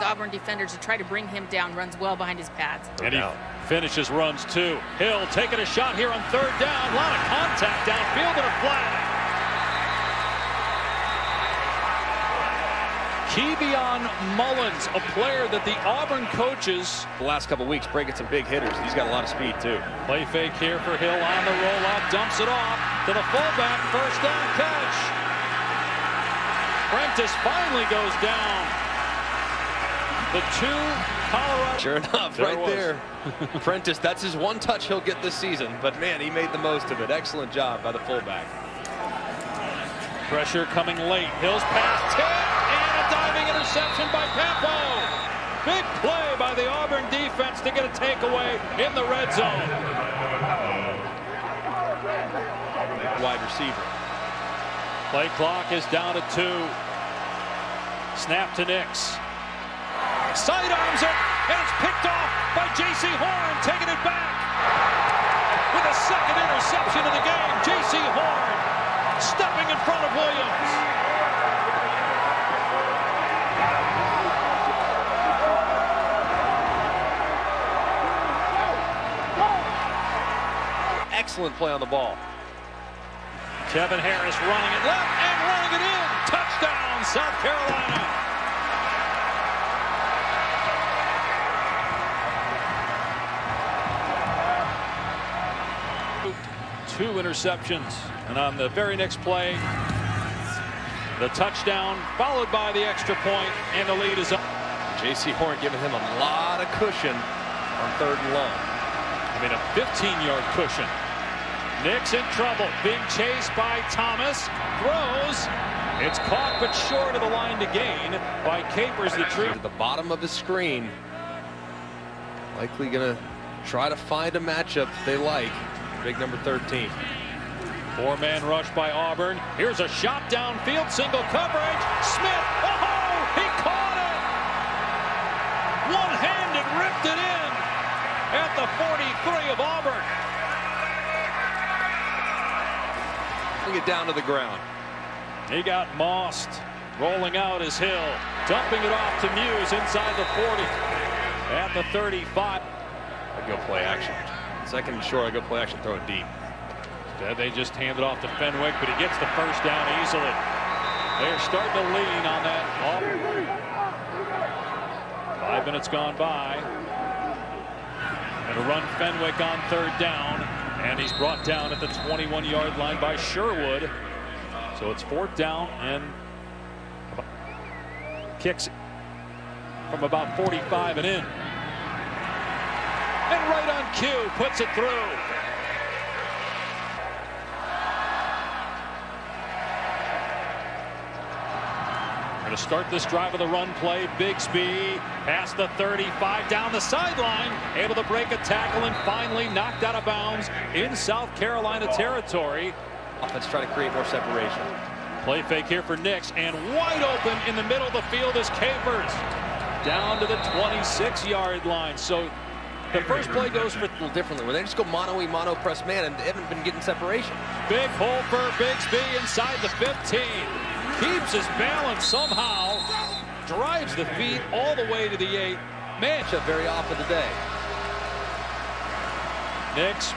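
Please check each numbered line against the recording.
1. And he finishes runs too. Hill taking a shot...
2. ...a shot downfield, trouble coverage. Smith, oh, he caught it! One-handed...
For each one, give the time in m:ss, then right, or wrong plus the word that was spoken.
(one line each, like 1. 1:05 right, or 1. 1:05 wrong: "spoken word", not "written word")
1. 0:03 right
2. 2:09 wrong: "single", not "trouble".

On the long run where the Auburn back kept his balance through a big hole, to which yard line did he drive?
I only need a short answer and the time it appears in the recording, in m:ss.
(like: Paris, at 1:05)
8, at 3:45.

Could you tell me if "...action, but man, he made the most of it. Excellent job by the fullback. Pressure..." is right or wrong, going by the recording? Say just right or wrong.
wrong.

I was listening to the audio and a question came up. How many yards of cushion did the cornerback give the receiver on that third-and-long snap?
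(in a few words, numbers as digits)
15.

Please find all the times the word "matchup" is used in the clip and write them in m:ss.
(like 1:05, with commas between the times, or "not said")
2:04, 3:45.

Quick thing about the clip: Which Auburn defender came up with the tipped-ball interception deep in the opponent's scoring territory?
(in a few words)
Campo.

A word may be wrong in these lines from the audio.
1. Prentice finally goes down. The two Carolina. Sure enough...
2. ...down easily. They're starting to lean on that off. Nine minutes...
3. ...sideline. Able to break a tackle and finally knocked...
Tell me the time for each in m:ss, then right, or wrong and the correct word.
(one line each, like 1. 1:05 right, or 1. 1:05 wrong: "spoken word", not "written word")
1. 0:26 wrong: "Colorado", not "Carolina"
2. 2:39 wrong: "Five", not "Nine"
3. 3:16 right.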